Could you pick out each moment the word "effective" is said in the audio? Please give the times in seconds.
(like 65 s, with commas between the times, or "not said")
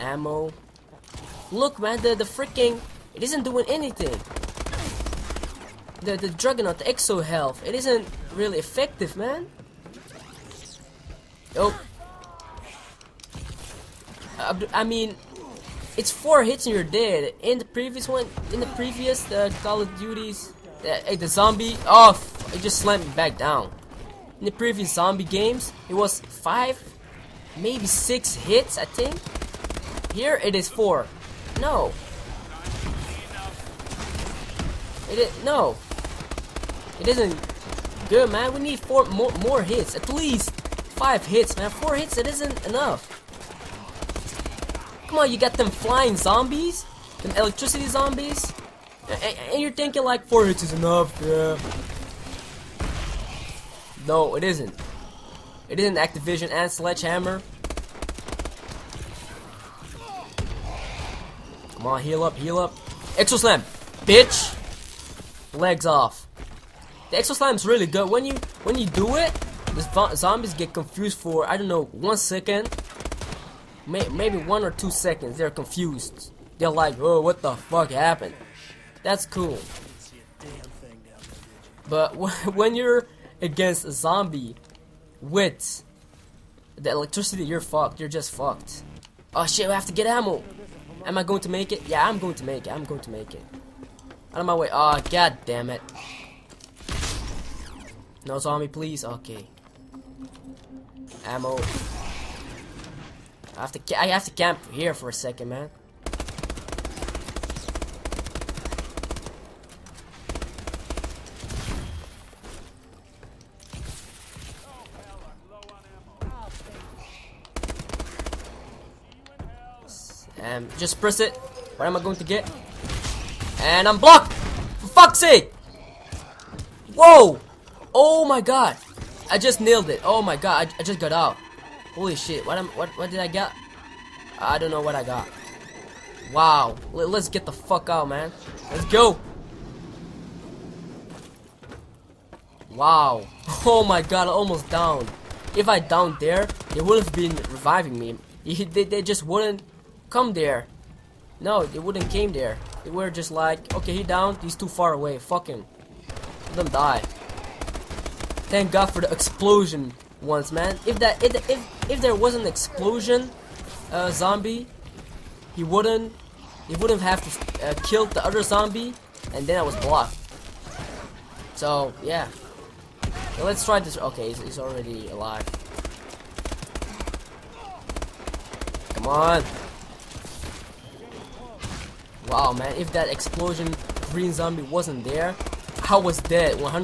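8 s.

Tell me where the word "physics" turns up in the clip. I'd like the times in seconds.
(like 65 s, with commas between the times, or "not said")
not said.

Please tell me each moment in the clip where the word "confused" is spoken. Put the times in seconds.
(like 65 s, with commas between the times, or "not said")
70 s, 75 s.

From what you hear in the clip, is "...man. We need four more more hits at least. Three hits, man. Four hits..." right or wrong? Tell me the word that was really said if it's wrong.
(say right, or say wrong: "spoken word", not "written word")
wrong: "Five", not "Three".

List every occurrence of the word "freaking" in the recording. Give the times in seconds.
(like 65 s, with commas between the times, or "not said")
2 s.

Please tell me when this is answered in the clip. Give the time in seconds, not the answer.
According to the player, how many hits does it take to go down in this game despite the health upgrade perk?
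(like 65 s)
15 s.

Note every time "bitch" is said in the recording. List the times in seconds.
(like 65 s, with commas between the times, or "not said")
64 s.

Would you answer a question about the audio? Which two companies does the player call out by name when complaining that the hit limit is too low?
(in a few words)
Activision and Sledgehammer.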